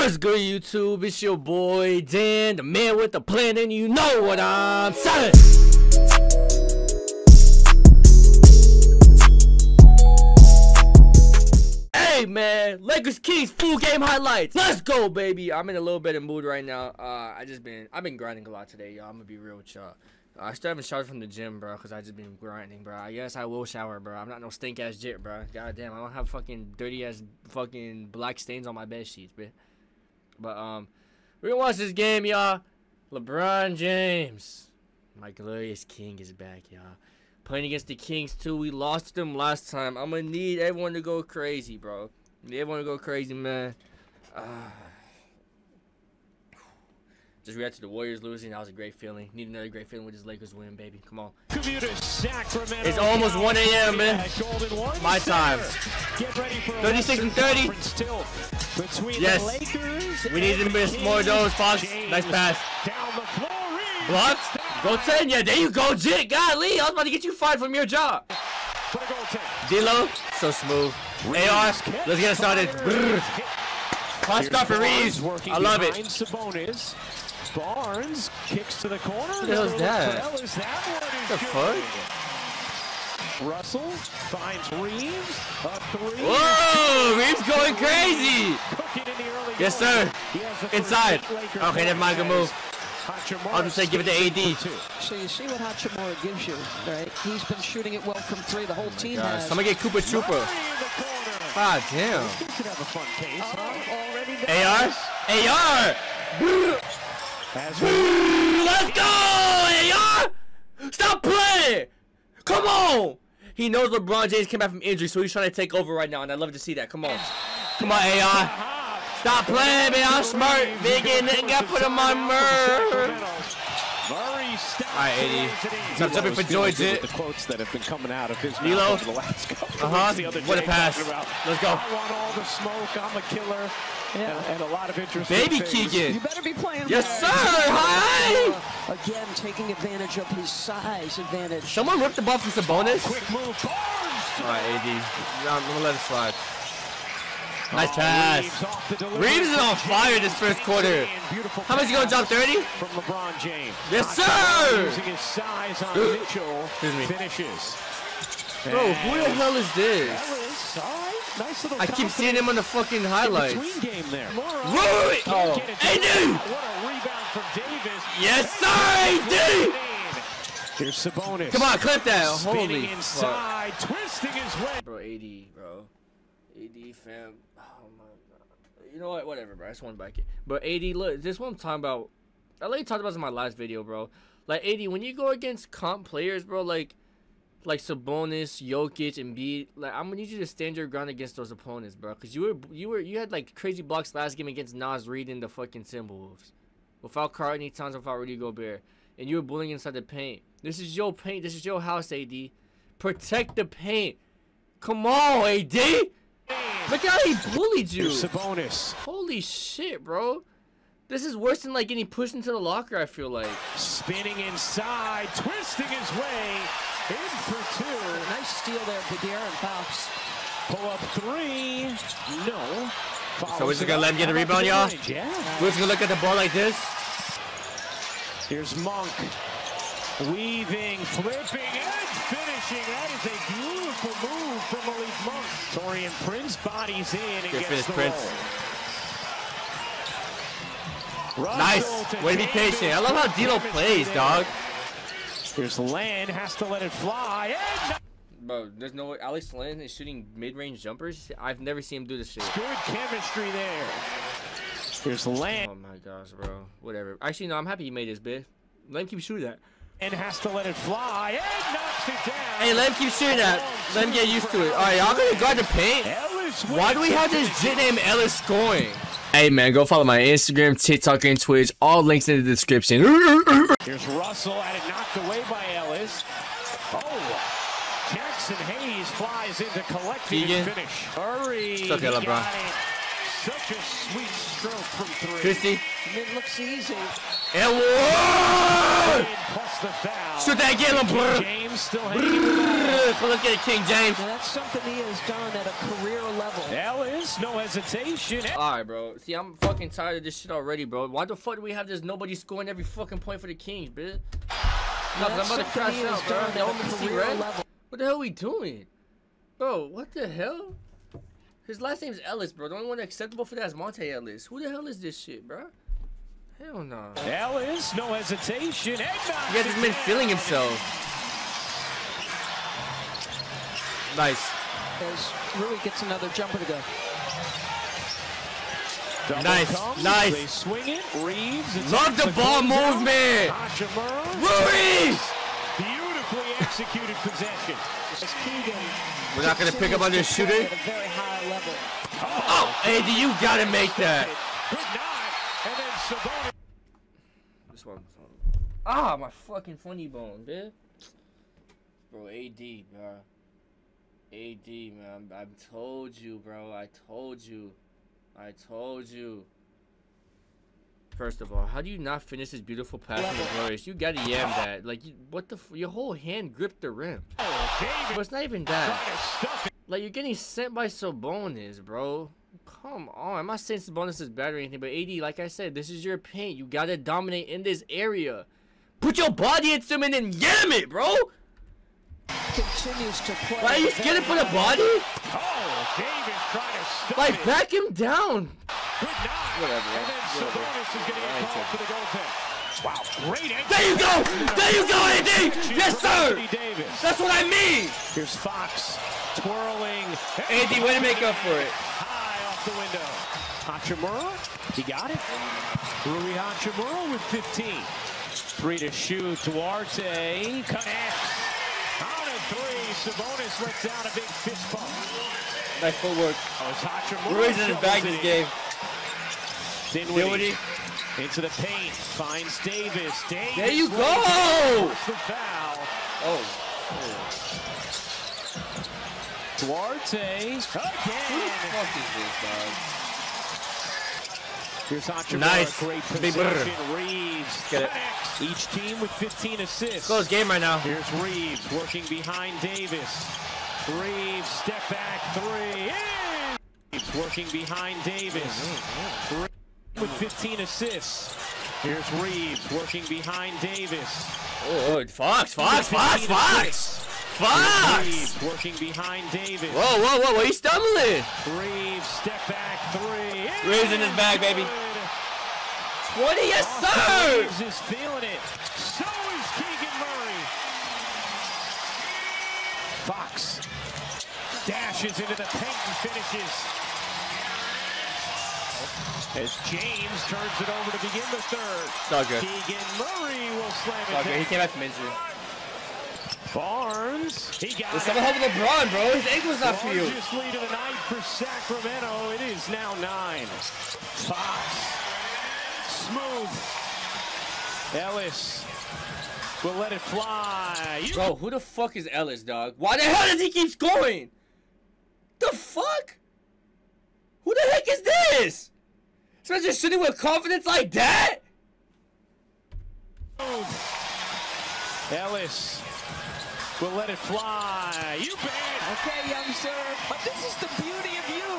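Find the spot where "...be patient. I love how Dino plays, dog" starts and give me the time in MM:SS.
04:02.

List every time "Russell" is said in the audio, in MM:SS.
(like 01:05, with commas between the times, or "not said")
01:23, 04:34.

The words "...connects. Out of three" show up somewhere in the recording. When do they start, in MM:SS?
06:50.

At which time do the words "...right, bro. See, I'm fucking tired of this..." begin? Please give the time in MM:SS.
04:58.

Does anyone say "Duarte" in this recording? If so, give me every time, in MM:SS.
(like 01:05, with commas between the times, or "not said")
06:49, 07:09.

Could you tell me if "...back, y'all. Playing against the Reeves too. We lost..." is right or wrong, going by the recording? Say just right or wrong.
wrong.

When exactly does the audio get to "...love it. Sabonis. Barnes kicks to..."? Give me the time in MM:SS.
01:15.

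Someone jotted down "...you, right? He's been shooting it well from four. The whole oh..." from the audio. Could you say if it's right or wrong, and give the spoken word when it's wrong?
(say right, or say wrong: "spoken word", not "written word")
wrong: "three", not "four".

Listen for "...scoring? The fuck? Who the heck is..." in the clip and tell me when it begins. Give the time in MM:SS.
08:23.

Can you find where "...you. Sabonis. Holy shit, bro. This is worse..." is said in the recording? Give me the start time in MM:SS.
03:27.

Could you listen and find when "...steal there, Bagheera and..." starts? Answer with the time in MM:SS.
03:38.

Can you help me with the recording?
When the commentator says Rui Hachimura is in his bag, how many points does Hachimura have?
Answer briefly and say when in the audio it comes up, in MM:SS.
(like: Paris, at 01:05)
15, at 06:46.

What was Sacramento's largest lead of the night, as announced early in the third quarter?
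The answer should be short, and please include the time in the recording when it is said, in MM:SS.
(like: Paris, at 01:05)
9, at 08:12.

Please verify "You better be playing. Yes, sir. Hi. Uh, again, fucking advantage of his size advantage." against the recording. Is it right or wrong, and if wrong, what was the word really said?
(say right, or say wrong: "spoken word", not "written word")
wrong: "taking", not "fucking".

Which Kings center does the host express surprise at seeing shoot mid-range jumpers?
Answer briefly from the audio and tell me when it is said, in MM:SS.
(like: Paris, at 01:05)
Alex Len, at 04:09.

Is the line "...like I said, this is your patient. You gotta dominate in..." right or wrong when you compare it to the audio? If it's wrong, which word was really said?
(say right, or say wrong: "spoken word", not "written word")
wrong: "paint", not "patient".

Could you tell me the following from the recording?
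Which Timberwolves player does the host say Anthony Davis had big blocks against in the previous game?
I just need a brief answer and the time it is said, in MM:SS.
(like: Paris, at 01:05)
Naz Reid, at 03:14.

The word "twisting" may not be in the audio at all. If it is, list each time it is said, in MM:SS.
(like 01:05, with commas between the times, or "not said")
02:53, 03:35.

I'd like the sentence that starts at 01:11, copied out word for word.
Reeves AR, let's get it started.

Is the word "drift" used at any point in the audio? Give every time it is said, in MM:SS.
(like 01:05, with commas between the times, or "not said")
not said.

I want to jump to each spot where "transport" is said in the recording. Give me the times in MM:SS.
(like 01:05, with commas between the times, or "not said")
not said.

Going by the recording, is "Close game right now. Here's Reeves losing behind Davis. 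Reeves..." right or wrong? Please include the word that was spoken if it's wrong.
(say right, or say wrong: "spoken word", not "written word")
wrong: "working", not "losing".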